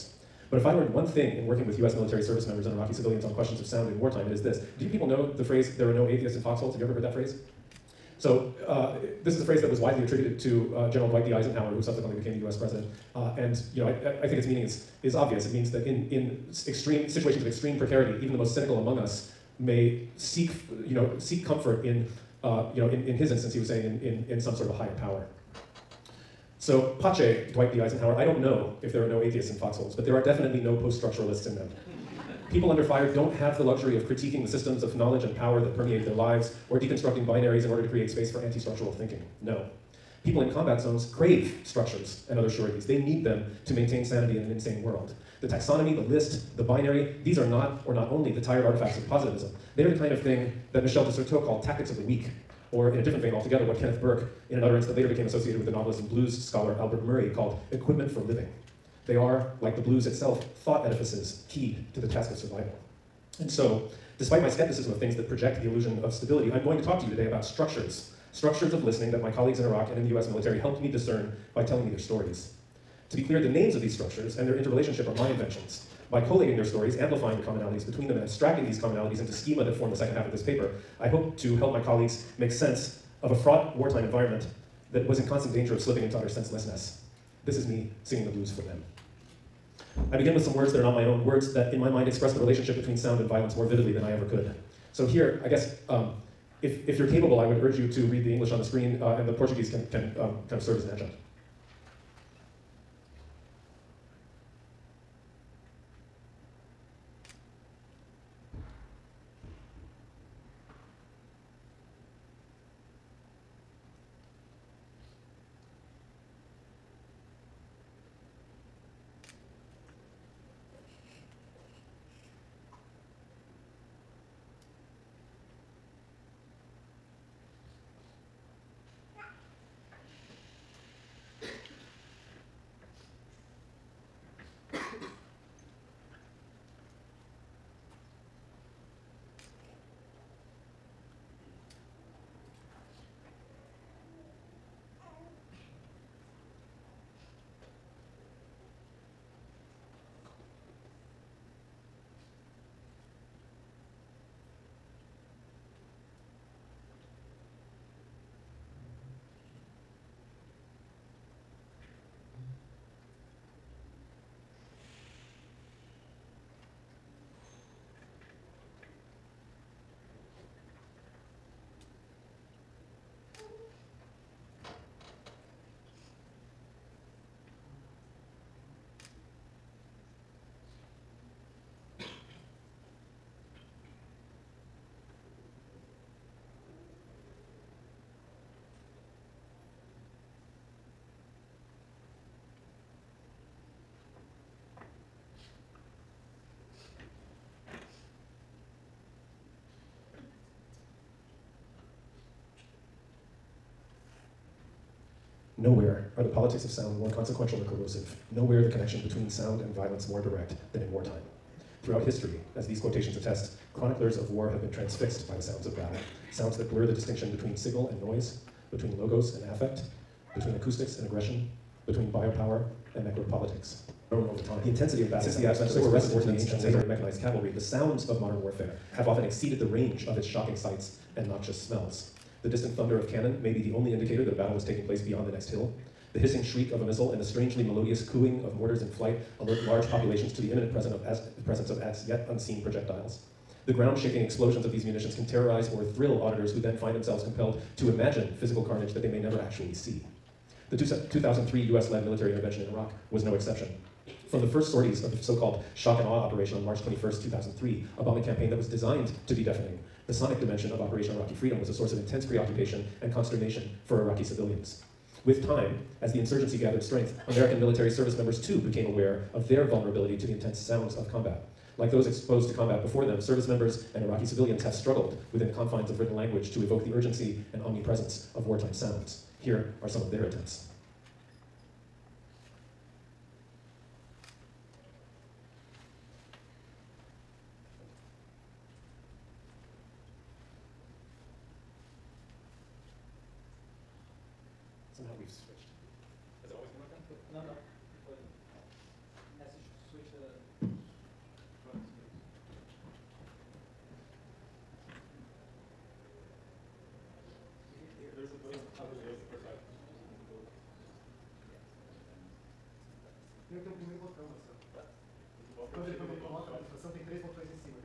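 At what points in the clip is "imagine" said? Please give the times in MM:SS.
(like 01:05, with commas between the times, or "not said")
04:07.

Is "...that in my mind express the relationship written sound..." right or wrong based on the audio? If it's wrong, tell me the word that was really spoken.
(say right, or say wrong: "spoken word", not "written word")
wrong: "between", not "written".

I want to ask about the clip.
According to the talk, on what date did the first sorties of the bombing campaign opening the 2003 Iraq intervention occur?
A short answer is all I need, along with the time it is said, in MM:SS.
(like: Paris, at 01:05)
March 21, 2003, at 04:16.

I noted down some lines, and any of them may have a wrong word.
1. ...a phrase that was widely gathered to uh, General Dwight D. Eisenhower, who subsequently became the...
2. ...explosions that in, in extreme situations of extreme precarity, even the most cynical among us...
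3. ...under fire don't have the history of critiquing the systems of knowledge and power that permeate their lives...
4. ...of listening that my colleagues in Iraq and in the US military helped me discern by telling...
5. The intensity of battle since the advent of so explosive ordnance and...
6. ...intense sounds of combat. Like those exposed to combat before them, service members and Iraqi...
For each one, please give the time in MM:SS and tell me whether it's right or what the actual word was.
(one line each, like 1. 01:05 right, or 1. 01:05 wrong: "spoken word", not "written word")
1. 00:09 wrong: "attributed", not "gathered"
2. 00:15 wrong: "means", not "explosions"
3. 00:32 wrong: "luxury", not "history"
4. 01:08 right
5. 03:44 right
6. 04:30 right.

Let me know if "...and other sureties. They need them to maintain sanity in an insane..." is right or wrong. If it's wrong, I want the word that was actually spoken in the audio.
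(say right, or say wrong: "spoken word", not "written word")
right.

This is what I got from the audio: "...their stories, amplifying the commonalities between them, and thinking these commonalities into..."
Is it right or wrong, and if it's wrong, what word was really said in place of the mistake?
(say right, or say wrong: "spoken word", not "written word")
wrong: "abstracting", not "thinking".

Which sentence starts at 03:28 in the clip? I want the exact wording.
Nowhere the connection between sound and violence more direct than in wartime.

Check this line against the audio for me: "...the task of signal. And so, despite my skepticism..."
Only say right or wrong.
wrong.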